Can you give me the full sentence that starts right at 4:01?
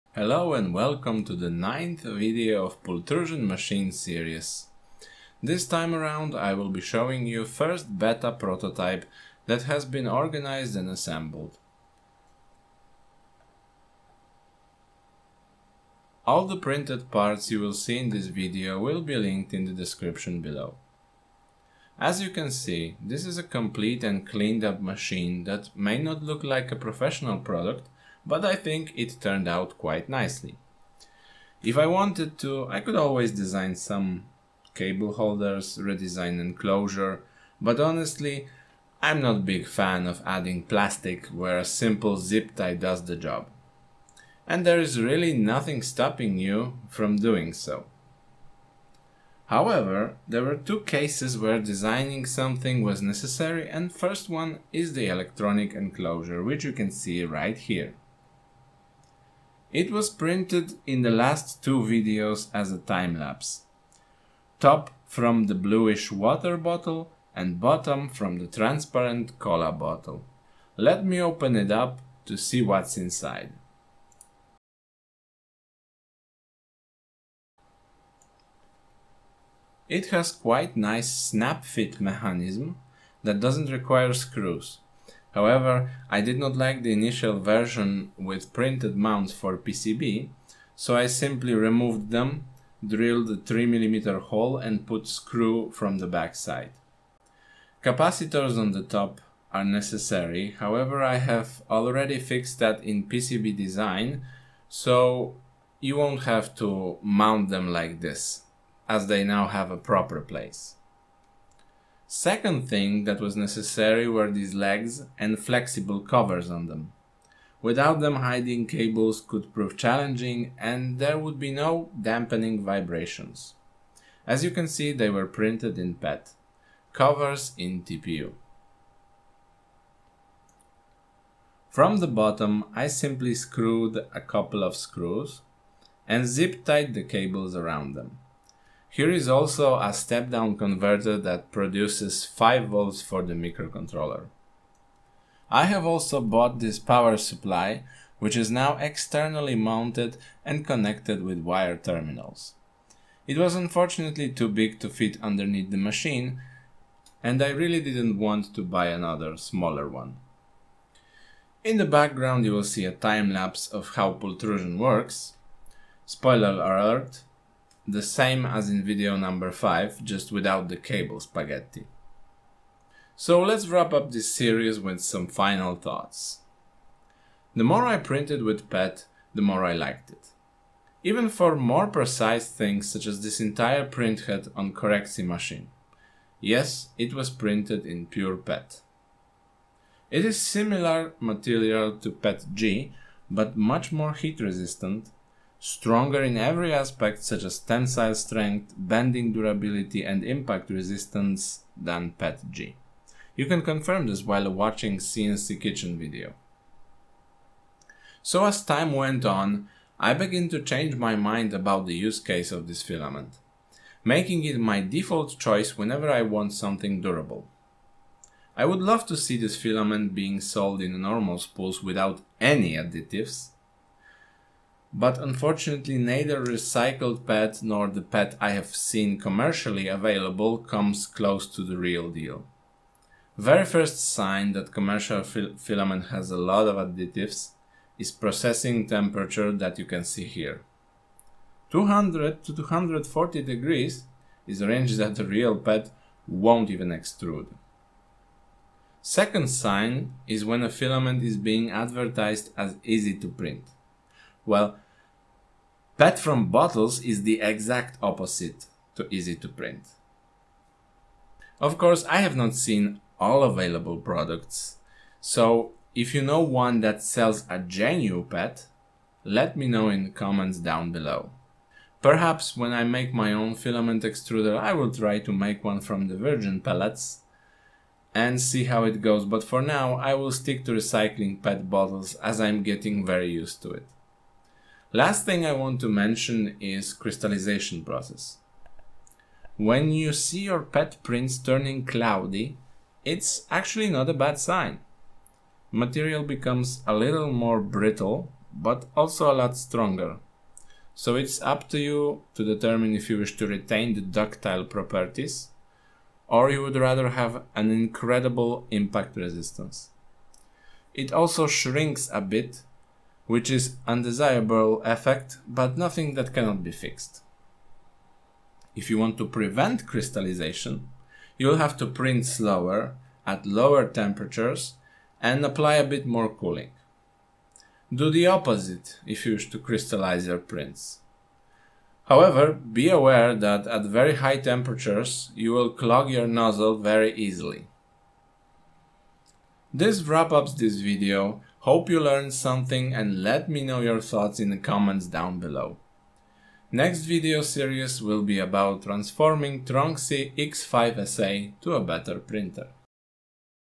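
200 to 240 degrees is a range that the real pet won't even extrude.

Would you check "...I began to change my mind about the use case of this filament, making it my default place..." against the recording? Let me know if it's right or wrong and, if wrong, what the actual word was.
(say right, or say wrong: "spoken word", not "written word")
wrong: "choice", not "place".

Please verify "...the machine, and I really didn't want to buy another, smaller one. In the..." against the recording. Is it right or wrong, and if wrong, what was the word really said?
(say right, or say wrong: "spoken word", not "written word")
right.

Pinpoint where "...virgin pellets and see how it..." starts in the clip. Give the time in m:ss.
4:36.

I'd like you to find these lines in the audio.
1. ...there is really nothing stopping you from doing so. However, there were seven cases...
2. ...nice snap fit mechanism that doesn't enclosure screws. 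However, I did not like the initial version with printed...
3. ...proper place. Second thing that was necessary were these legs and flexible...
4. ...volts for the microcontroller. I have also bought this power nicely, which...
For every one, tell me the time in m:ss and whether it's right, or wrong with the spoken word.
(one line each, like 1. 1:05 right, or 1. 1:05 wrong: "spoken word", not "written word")
1. 0:44 wrong: "two", not "seven"
2. 1:20 wrong: "require", not "enclosure"
3. 1:49 right
4. 2:22 wrong: "supply", not "nicely".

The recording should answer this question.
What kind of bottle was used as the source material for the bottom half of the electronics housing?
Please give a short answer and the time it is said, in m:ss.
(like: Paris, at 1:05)
transparent cola bottle, at 1:08.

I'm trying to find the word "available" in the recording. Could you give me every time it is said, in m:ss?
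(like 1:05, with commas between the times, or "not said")
3:49, 4:23.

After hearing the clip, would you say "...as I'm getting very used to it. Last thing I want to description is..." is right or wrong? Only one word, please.
wrong.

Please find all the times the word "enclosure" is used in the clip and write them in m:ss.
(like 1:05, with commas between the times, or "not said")
0:36, 0:55.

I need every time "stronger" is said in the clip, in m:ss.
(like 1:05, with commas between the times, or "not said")
3:15, 4:59.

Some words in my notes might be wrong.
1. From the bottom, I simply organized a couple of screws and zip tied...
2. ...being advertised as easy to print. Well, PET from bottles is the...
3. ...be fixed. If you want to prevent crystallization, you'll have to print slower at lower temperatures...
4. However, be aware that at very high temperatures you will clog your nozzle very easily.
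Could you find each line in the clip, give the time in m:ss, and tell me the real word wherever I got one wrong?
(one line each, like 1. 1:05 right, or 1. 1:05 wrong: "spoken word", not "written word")
1. 2:11 wrong: "screwed", not "organized"
2. 4:11 right
3. 5:16 right
4. 5:32 right.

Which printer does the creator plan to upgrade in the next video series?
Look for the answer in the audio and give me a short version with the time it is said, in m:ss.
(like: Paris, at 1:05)
Tronxy X5 SA, at 5:49.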